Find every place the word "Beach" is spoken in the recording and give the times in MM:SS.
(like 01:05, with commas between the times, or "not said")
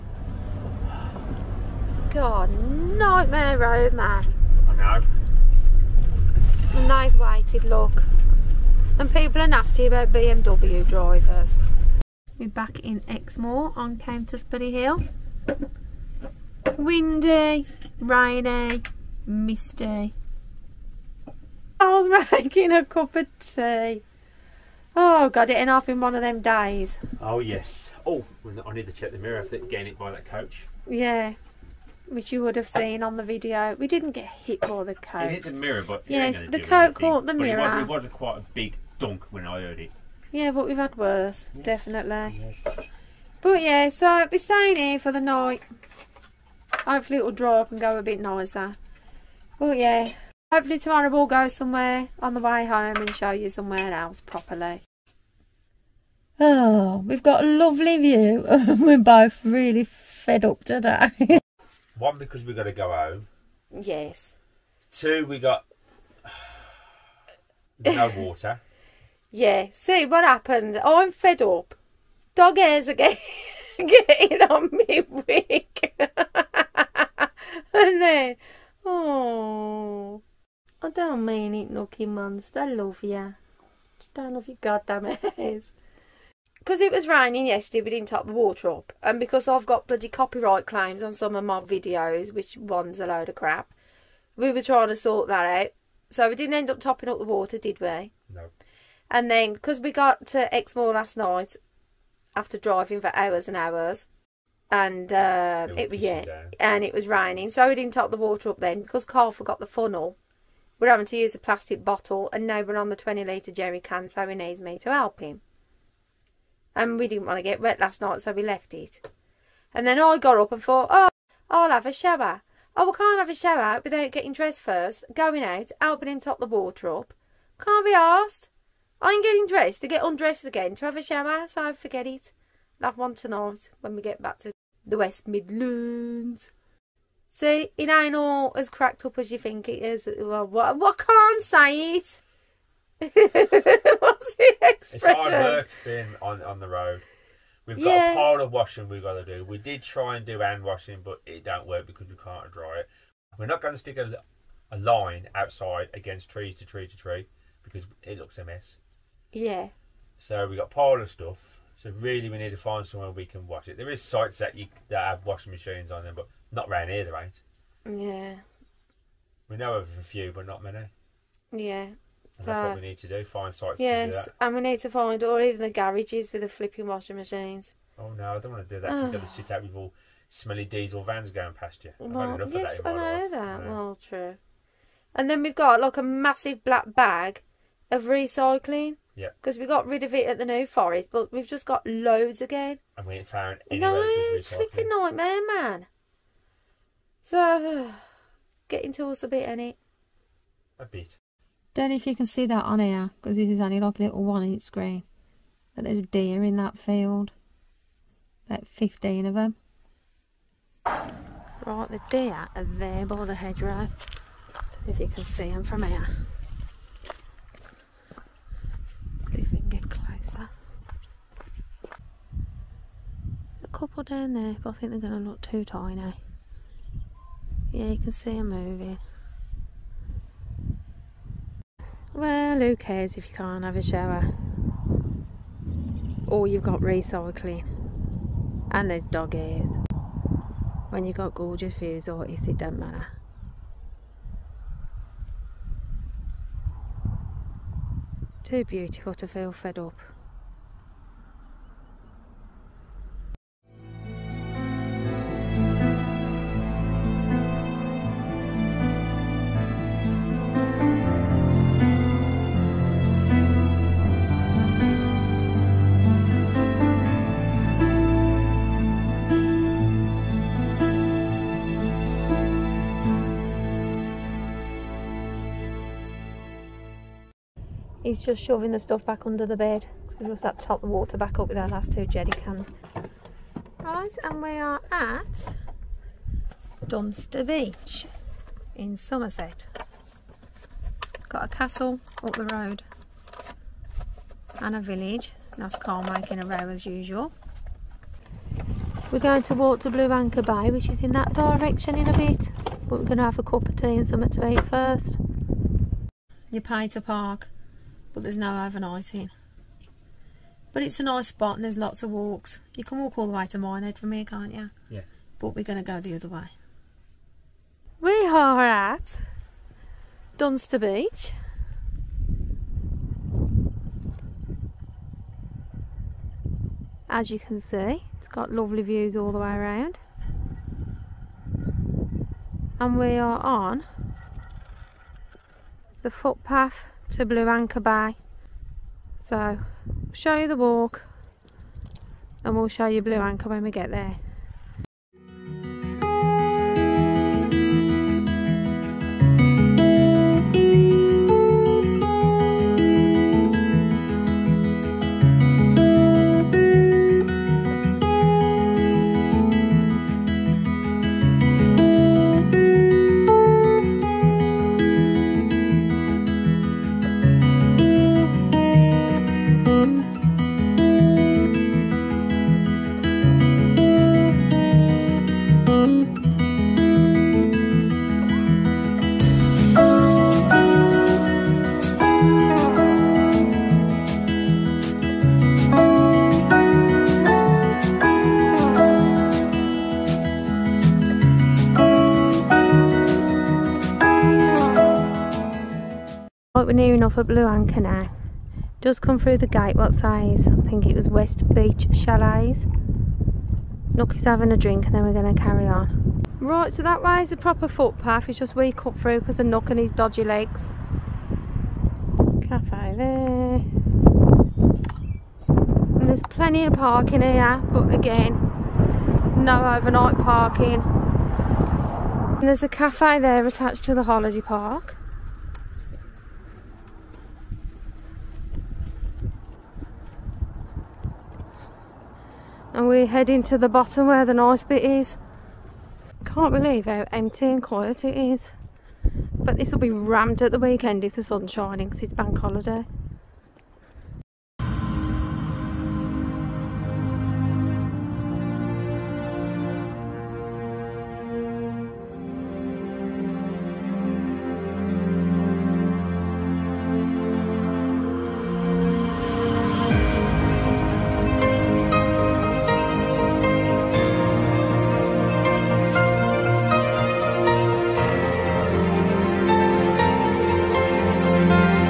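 04:47, 05:20, 06:41.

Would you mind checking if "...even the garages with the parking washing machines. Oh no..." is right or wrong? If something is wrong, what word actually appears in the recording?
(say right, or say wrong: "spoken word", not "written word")
wrong: "flipping", not "parking".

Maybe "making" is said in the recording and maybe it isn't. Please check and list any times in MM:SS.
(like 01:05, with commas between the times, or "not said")
00:22, 04:56.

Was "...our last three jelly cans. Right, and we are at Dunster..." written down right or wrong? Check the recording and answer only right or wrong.
wrong.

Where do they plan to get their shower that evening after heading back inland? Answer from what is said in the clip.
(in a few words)
West Midlands.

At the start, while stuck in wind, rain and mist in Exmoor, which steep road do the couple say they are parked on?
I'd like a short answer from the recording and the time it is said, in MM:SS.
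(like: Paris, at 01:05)
Countisbury Hill, at 00:13.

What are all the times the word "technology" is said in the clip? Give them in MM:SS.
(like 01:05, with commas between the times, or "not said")
not said.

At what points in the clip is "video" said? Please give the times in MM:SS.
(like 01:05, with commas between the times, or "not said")
00:33, 01:31.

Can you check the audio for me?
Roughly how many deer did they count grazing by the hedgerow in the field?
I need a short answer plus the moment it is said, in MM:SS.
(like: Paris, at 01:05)
15, at 03:28.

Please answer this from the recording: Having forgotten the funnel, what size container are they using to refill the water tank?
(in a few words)
20 litres.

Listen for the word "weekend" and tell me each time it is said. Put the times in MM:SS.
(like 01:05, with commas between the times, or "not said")
07:20.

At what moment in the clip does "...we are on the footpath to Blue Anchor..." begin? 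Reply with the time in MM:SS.
05:32.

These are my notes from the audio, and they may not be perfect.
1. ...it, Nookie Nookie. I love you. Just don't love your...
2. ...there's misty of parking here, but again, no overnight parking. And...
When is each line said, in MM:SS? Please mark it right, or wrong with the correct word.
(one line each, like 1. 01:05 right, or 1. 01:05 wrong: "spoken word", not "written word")
1. 01:21 wrong: "Muns", not "Nookie"
2. 06:56 wrong: "plenty", not "misty".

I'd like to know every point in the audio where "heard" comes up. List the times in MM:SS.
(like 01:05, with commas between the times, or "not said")
00:39.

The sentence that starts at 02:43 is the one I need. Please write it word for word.
There is sites that you that have washing machines on them, but not round here, there ain't.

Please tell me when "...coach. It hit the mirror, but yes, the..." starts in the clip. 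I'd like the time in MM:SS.
00:34.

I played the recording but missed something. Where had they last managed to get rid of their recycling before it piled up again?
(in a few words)
New Forest.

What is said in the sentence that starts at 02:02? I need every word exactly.
Oh, we can't have a shower without getting dressed first, going out, helping him top the water up.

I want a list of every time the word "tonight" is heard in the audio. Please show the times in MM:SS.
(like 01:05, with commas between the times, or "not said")
02:13.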